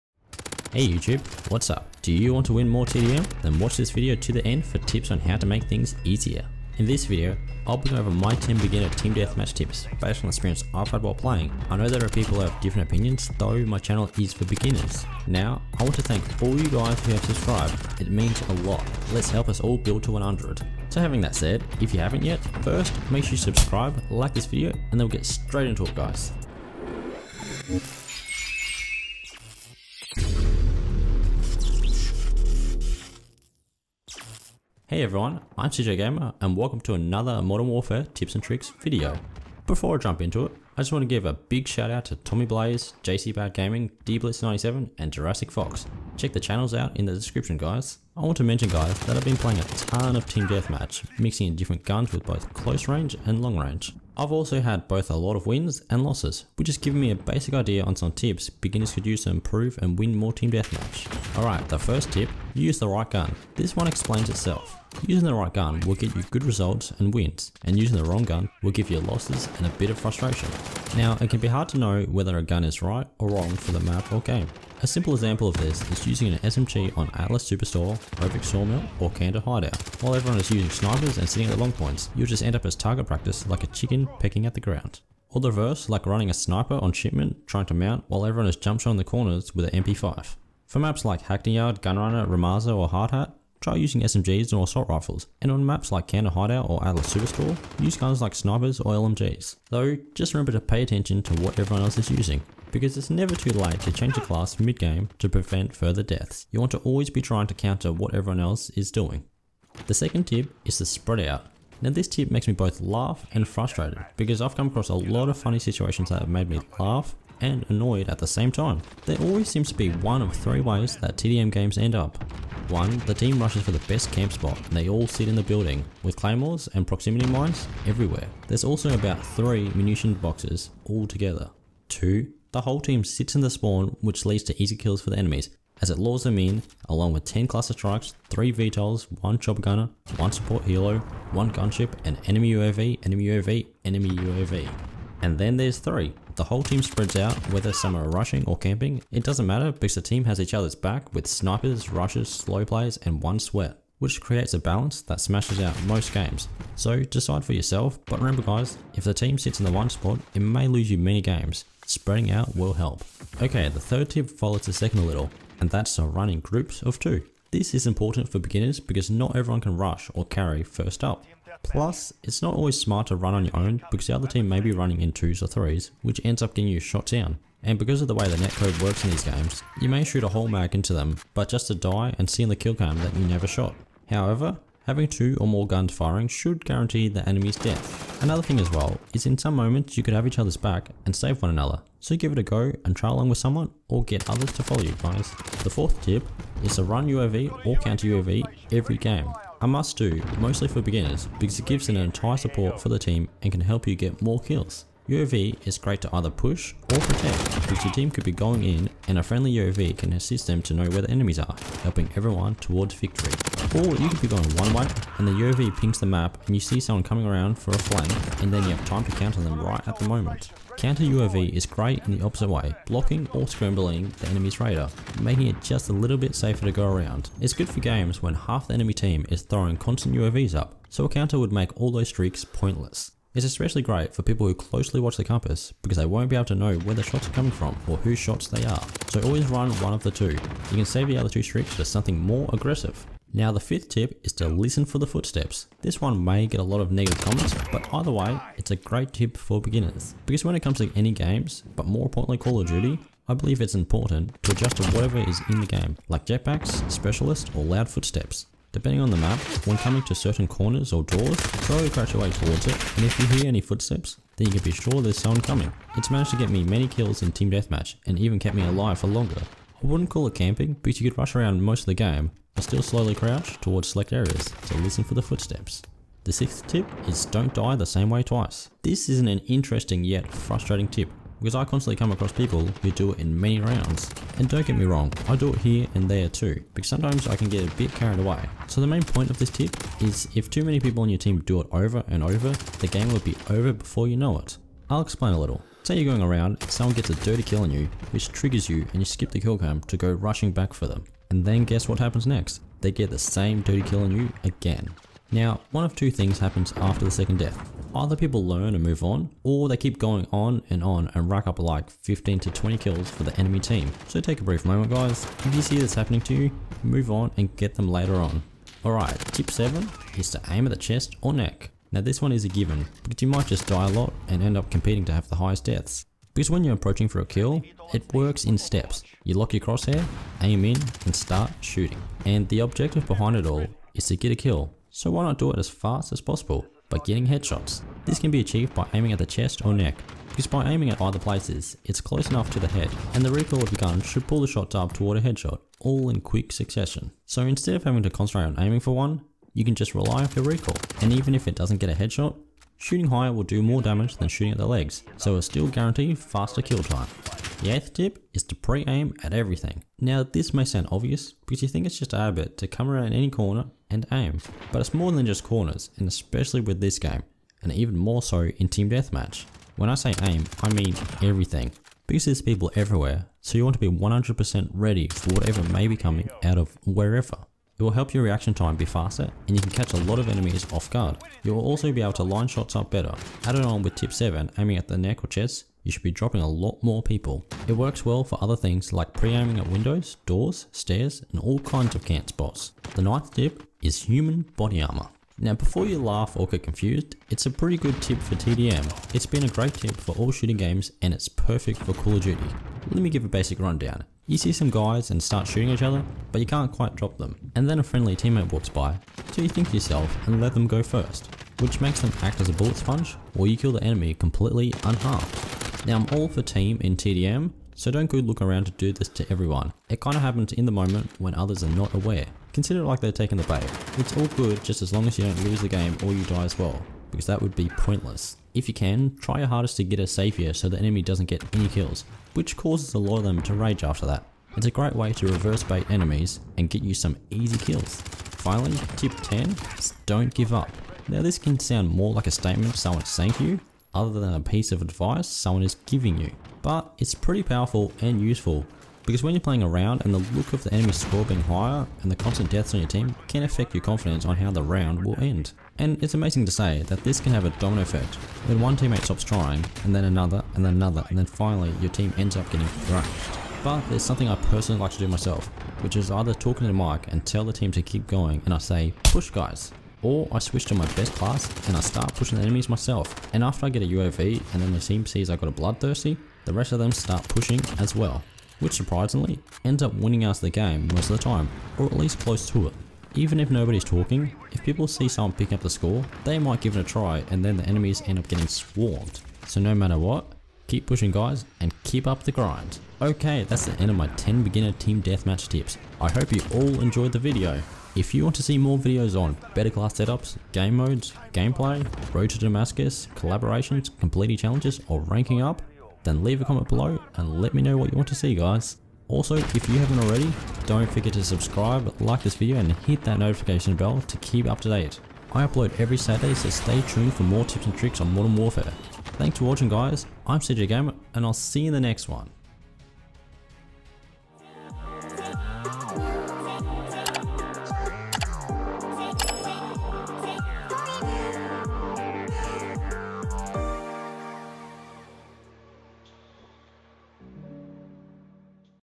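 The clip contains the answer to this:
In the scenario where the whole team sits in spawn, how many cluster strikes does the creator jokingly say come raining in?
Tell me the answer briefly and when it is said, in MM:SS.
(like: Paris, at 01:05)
10, at 02:17.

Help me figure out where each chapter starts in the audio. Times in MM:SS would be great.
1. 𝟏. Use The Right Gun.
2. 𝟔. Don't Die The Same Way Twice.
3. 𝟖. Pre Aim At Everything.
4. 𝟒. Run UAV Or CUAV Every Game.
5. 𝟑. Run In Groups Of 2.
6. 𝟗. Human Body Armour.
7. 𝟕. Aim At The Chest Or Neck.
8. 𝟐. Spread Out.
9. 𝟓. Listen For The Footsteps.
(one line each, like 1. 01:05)
1. 01:02
2. 04:37
3. 05:58
4. 03:16
5. 02:45
6. 06:34
7. 05:20
8. 01:50
9. 04:04.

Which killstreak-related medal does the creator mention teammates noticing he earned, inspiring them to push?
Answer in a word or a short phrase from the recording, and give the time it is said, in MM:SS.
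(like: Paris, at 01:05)
bloodthirsty, at 07:55.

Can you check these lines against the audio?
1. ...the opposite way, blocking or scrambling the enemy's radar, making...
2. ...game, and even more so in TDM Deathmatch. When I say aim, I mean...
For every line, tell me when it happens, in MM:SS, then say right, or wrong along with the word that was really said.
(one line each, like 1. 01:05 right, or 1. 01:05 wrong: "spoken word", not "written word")
1. 03:42 right
2. 06:06 wrong: "Team", not "TDM".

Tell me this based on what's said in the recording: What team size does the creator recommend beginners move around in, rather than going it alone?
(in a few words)
groups of two.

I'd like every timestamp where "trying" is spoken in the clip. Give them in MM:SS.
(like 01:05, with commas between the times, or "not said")
01:27, 01:47, 07:39.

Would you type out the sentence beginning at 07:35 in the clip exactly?
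And it's amazing to say that this can have a domino effect.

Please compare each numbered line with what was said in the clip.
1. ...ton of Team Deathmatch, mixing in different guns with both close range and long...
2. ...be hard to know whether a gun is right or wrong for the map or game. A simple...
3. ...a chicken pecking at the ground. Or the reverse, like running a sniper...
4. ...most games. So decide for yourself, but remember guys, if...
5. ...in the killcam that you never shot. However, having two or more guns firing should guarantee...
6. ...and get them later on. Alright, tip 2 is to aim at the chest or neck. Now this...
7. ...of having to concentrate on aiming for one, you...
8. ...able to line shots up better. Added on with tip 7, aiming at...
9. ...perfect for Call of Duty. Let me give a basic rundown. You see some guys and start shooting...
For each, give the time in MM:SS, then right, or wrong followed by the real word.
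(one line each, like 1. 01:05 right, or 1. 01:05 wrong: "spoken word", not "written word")
1. 00:49 right
2. 01:11 right
3. 01:23 right
4. 02:35 right
5. 03:02 right
6. 05:17 wrong: "7", not "2"
7. 05:47 right
8. 06:22 right
9. 06:41 right.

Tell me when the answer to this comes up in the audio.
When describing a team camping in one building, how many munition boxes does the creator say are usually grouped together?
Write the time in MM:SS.
02:08.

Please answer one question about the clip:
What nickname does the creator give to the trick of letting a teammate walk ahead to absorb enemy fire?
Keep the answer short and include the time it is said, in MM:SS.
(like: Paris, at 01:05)
human body armor, at 06:34.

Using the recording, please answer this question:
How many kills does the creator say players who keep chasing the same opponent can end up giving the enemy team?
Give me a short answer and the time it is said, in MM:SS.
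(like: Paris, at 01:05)
15 to 20, at 05:11.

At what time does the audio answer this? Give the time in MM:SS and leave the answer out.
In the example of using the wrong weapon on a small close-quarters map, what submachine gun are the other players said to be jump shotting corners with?
01:29.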